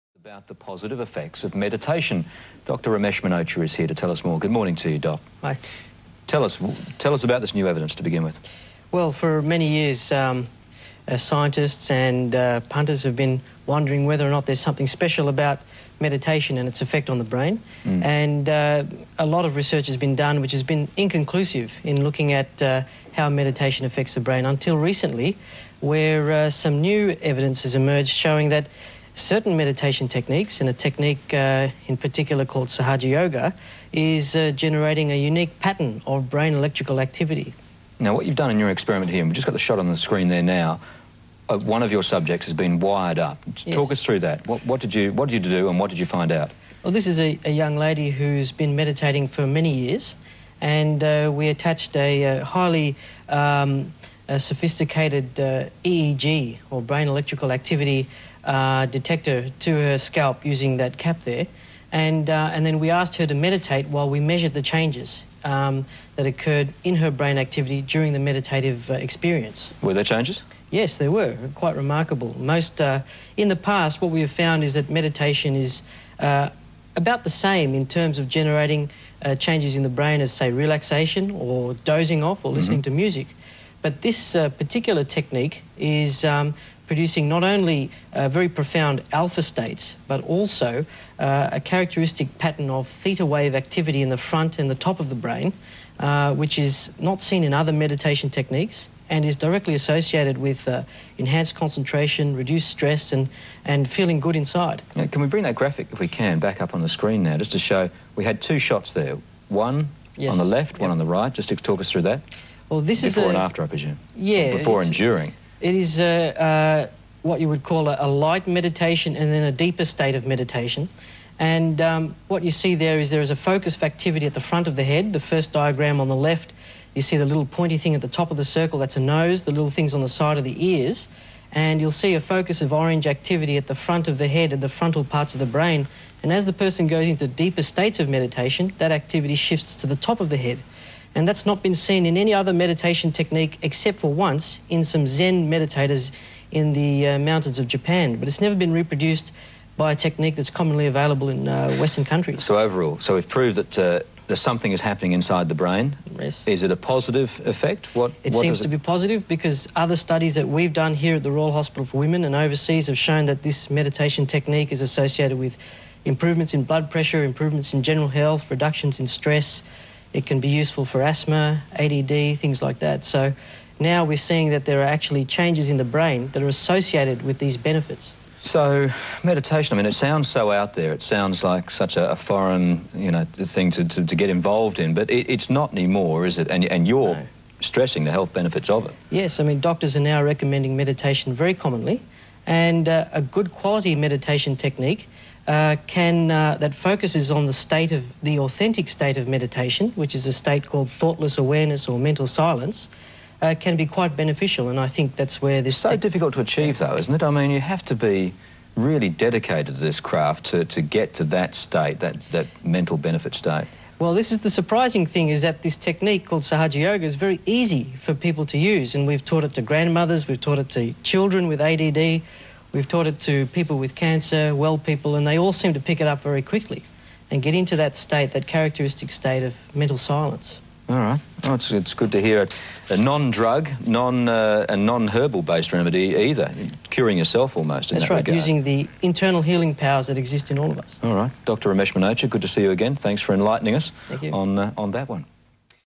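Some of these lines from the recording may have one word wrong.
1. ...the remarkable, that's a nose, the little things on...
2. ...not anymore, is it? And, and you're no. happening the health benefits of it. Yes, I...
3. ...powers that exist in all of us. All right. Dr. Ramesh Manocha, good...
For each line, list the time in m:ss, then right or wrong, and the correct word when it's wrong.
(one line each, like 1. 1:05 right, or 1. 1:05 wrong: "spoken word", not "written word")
1. 2:08 wrong: "circle", not "remarkable"
2. 3:05 wrong: "stressing", not "happening"
3. 3:59 right.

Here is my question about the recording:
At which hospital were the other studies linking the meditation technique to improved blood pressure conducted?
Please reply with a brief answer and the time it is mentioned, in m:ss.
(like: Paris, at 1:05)
Royal Hospital for Women, at 2:41.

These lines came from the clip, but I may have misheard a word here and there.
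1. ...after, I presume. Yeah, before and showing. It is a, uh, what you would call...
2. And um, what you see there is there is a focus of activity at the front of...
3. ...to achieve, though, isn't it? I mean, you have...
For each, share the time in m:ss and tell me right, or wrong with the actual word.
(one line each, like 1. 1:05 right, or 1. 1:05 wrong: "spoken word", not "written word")
1. 1:53 wrong: "during", not "showing"
2. 2:01 right
3. 3:26 right.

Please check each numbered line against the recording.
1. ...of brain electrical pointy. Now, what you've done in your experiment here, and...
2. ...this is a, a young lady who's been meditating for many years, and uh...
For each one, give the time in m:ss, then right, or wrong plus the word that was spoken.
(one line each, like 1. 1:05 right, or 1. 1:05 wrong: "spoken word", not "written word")
1. 0:36 wrong: "activity", not "pointy"
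2. 0:46 right.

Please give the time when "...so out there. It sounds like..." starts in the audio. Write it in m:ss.
3:00.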